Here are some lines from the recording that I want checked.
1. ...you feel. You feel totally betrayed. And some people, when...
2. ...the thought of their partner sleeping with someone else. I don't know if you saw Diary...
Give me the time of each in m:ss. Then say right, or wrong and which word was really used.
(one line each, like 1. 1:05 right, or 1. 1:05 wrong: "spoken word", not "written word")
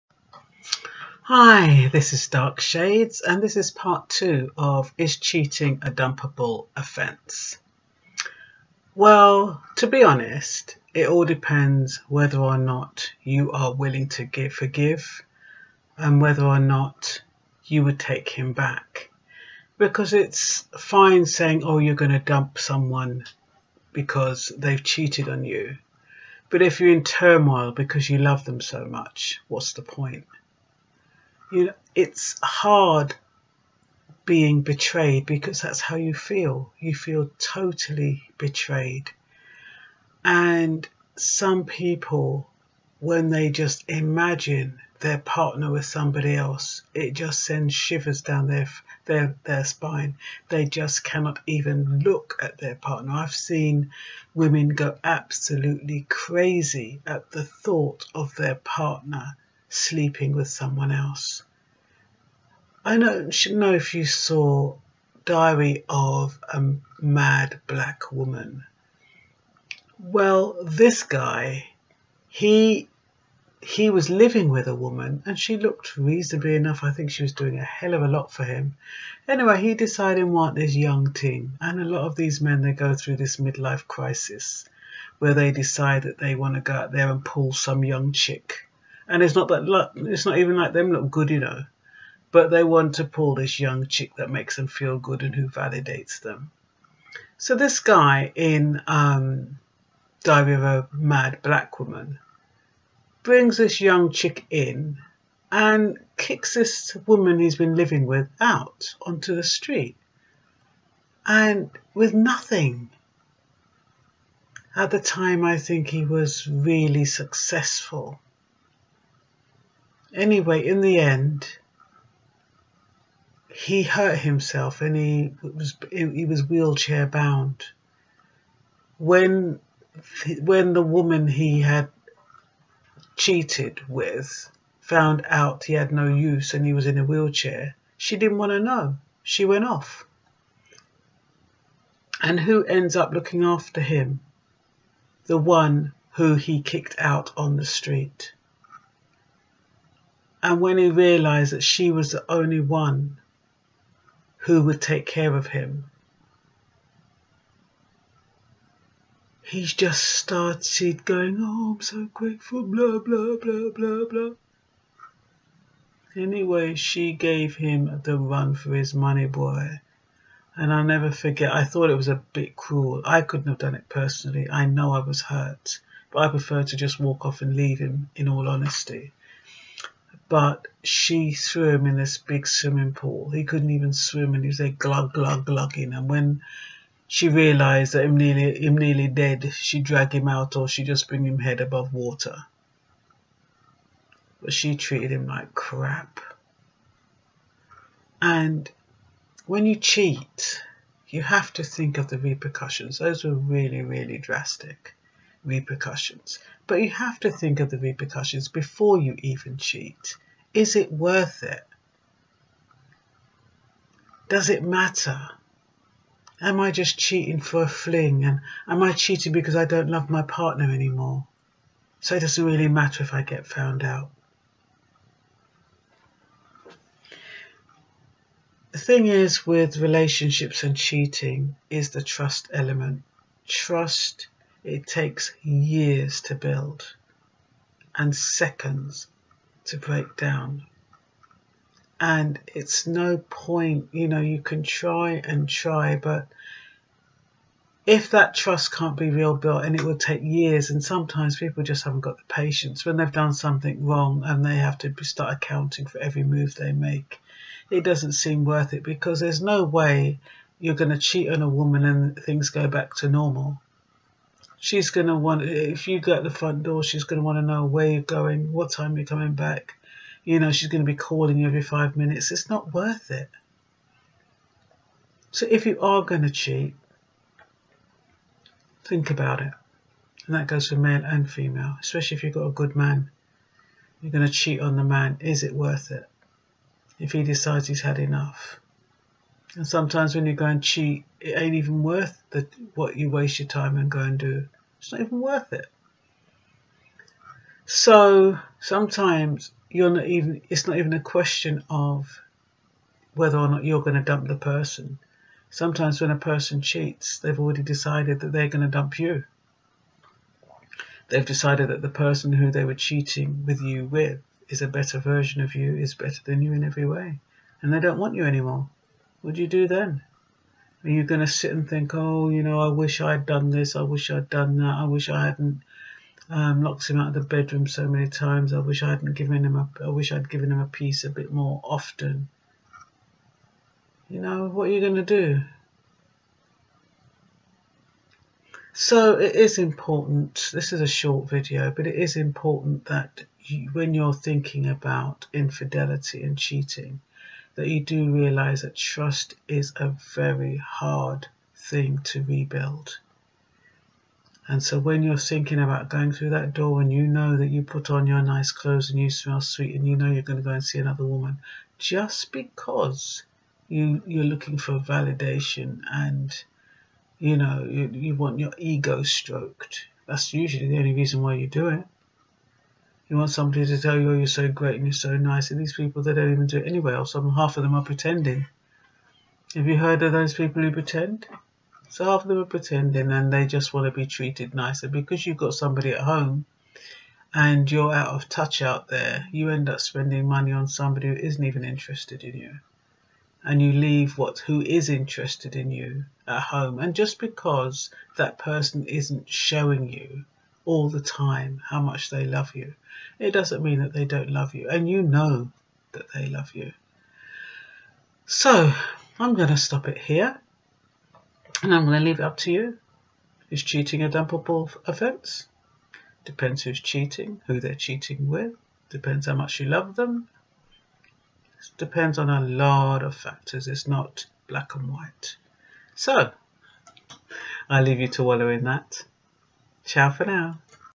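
1. 0:35 right
2. 0:57 right.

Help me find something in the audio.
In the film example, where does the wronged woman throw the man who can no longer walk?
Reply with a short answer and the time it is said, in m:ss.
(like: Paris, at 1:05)
swimming pool, at 3:02.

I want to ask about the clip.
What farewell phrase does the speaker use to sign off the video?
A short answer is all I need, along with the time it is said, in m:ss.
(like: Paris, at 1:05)
Ciao for now, at 7:09.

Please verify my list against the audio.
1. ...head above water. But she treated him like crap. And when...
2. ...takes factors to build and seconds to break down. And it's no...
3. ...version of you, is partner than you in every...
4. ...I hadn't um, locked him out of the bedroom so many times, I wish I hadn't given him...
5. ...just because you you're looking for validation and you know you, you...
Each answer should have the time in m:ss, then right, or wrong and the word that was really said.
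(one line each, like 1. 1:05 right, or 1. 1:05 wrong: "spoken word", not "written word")
1. 3:11 right
2. 3:54 wrong: "years", not "factors"
3. 5:14 wrong: "better", not "partner"
4. 5:25 right
5. 6:01 right.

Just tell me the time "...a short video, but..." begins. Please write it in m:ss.
5:40.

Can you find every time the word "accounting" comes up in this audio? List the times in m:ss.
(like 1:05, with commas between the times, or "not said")
4:15.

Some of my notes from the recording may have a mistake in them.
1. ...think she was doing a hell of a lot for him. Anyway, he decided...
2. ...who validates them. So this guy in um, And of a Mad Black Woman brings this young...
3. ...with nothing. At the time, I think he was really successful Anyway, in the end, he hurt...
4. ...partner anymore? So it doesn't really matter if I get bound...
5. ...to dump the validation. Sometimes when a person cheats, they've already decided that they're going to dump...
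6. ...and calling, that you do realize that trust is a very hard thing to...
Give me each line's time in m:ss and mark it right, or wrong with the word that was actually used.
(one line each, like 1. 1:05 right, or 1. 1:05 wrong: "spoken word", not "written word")
1. 1:16 right
2. 1:35 wrong: "Diary", not "And"
3. 1:51 right
4. 3:40 wrong: "found", not "bound"
5. 5:03 wrong: "person", not "validation"
6. 5:46 wrong: "cheating", not "calling".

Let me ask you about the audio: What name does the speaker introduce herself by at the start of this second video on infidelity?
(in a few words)
Dark Shades.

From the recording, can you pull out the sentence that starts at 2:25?
The one who he kicked out on the street.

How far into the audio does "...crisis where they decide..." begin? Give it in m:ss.
1:23.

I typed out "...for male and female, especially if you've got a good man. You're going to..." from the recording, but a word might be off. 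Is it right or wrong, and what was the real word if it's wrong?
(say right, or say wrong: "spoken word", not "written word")
right.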